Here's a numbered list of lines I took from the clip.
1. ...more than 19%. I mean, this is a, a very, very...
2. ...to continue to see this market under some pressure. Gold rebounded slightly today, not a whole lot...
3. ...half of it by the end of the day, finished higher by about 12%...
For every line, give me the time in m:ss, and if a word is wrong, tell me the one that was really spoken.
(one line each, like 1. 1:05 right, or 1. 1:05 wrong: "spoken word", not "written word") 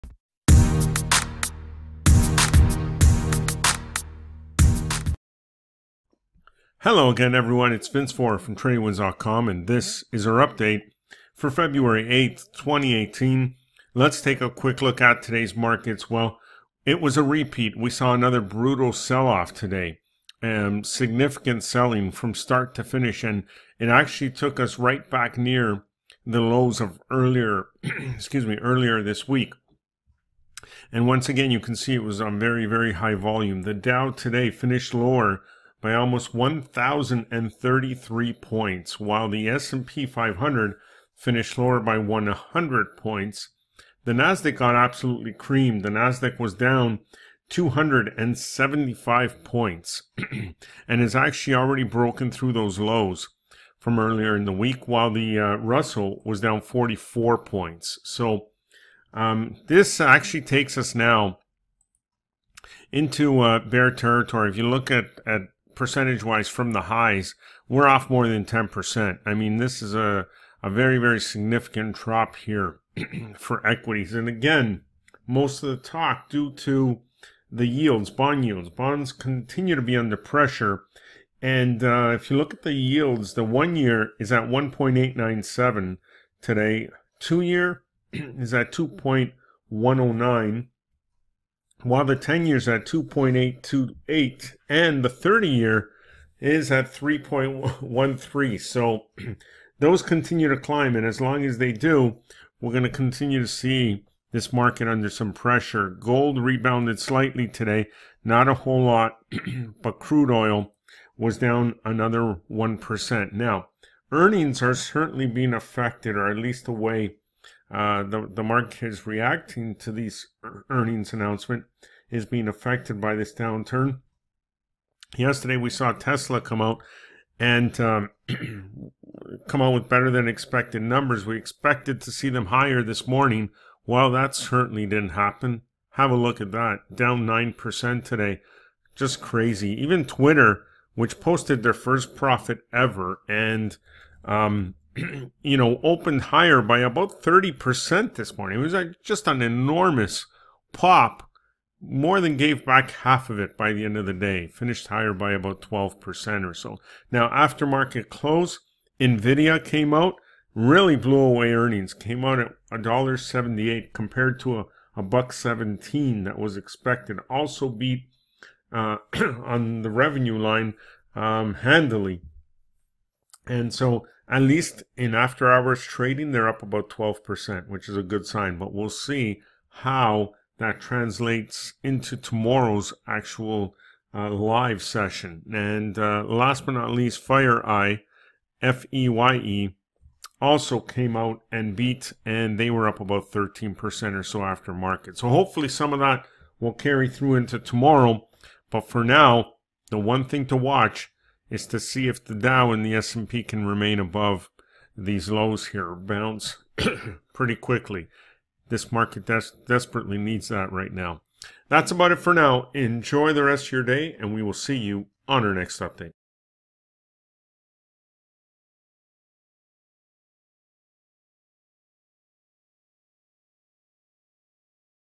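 1. 1:08 wrong: "10", not "19"
2. 1:42 right
3. 2:32 right.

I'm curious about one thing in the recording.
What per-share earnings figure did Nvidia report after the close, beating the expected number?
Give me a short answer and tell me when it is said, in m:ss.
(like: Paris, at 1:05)
$1.78, at 2:42.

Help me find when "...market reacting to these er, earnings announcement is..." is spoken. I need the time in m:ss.
1:58.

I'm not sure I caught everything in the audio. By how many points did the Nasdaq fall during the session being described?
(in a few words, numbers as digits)
275.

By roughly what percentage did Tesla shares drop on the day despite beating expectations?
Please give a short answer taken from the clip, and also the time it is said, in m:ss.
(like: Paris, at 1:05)
9%, at 2:17.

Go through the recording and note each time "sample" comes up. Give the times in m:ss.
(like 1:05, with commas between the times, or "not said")
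not said.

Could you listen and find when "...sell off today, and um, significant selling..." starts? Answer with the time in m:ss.
0:18.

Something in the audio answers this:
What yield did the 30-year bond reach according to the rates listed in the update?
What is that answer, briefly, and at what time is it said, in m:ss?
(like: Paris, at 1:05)
3.13, at 1:36.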